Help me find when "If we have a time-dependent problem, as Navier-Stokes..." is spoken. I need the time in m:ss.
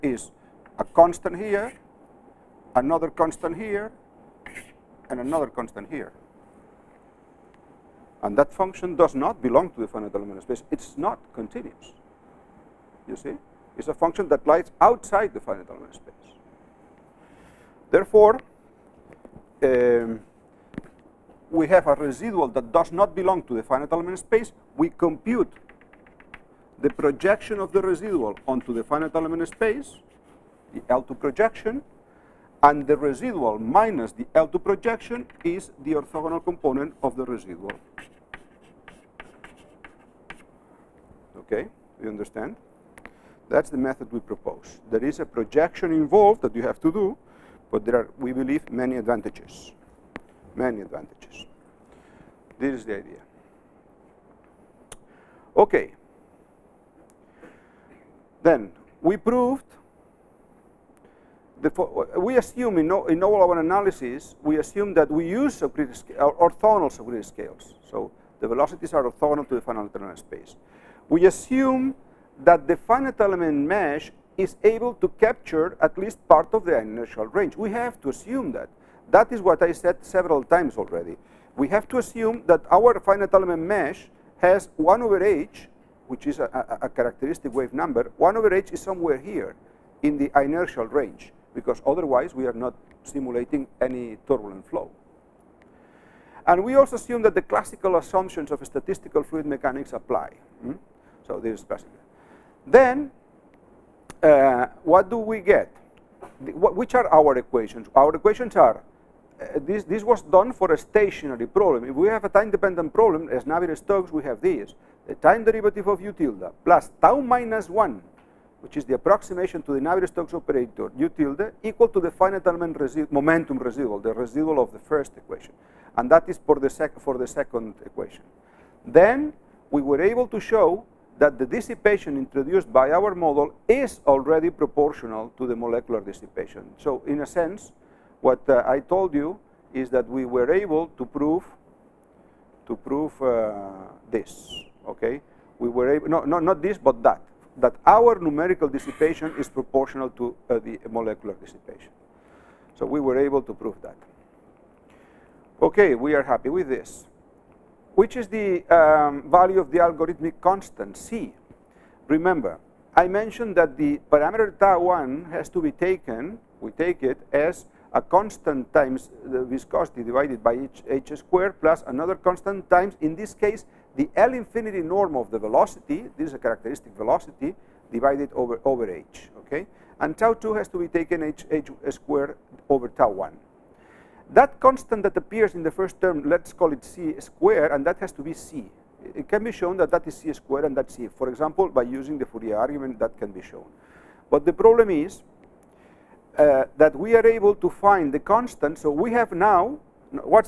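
1:51.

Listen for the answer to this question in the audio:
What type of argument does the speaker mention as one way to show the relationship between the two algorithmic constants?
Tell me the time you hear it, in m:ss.
3:12.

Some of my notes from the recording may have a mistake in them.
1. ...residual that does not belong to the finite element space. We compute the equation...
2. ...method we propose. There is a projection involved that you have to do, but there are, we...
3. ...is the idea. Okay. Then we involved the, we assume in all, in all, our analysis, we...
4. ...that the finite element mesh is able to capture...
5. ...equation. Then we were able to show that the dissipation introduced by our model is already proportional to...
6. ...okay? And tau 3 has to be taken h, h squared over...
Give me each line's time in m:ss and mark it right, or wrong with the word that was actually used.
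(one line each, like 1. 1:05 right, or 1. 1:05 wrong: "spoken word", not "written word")
1. 0:21 wrong: "projection", not "equation"
2. 0:43 right
3. 0:52 wrong: "proved", not "involved"
4. 1:12 right
5. 2:07 right
6. 2:59 wrong: "2", not "3".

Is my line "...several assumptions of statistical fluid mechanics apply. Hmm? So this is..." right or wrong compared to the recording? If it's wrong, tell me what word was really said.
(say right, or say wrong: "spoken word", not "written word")
wrong: "classical", not "several".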